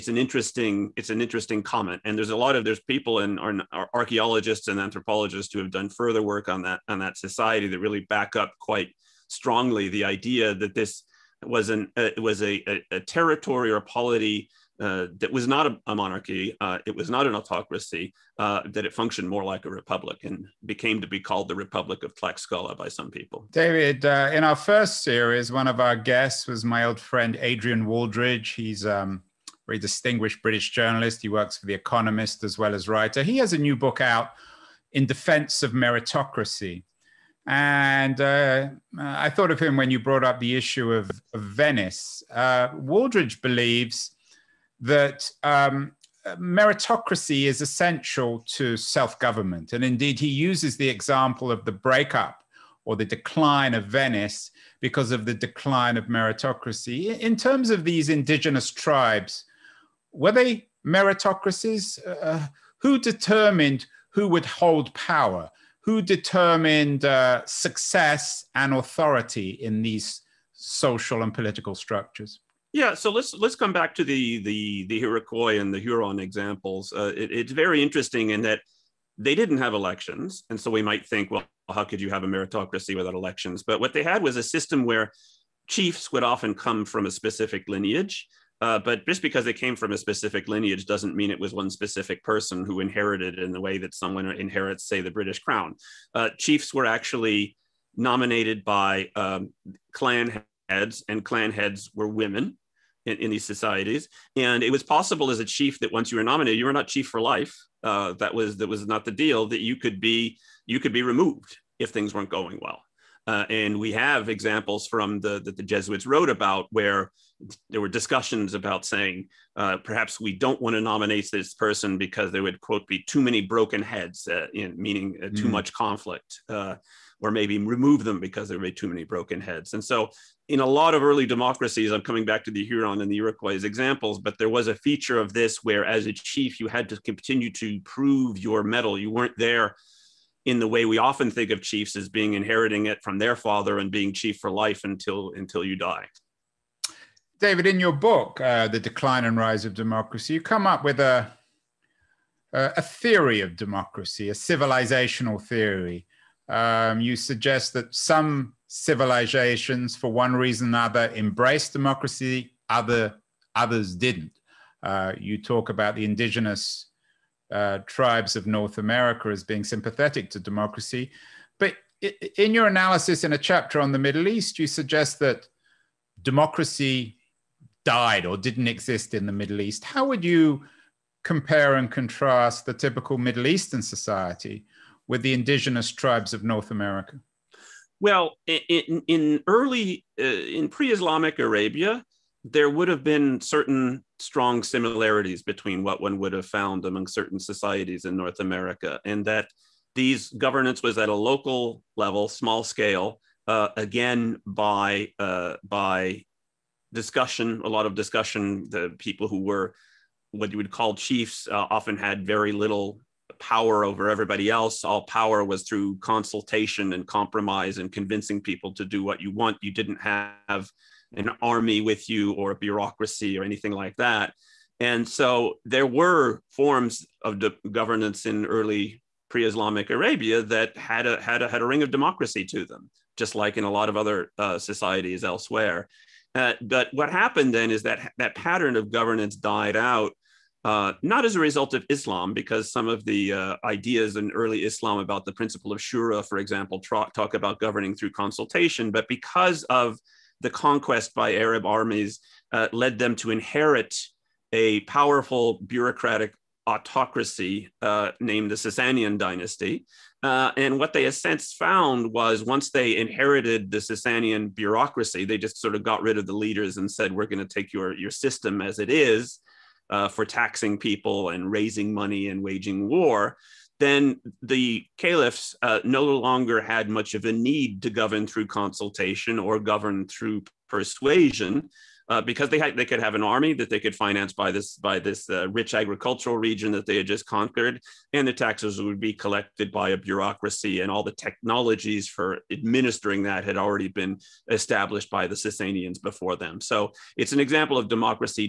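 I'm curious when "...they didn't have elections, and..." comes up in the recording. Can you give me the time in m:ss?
1:19.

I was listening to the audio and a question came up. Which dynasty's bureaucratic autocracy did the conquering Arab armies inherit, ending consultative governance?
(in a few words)
Sasanian dynasty.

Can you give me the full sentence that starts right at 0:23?
David, uh, in our first series, one of our guests was my old friend Adrian Wooldridge.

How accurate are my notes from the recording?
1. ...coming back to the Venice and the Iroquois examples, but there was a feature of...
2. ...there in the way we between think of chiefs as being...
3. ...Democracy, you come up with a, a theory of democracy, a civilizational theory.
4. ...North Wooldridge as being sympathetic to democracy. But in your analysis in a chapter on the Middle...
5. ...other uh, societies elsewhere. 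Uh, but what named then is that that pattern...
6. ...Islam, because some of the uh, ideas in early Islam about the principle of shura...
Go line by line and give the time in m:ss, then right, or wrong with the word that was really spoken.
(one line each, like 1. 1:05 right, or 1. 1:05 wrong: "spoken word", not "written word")
1. 2:12 wrong: "Huron", not "Venice"
2. 2:19 wrong: "often", not "between"
3. 2:29 right
4. 2:48 wrong: "America", not "Wooldridge"
5. 3:53 wrong: "happened", not "named"
6. 4:01 right.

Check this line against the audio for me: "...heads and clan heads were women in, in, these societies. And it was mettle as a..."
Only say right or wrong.
wrong.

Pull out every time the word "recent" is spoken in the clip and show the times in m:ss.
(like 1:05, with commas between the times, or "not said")
not said.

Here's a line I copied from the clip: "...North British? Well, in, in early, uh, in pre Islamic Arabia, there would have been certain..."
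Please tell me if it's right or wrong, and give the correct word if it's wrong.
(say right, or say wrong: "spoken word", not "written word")
wrong: "America", not "British".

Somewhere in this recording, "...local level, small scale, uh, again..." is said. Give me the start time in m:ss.
3:21.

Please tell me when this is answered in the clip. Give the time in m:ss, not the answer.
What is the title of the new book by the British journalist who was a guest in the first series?
0:34.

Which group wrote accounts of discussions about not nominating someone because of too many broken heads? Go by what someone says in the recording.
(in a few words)
The Jesuits.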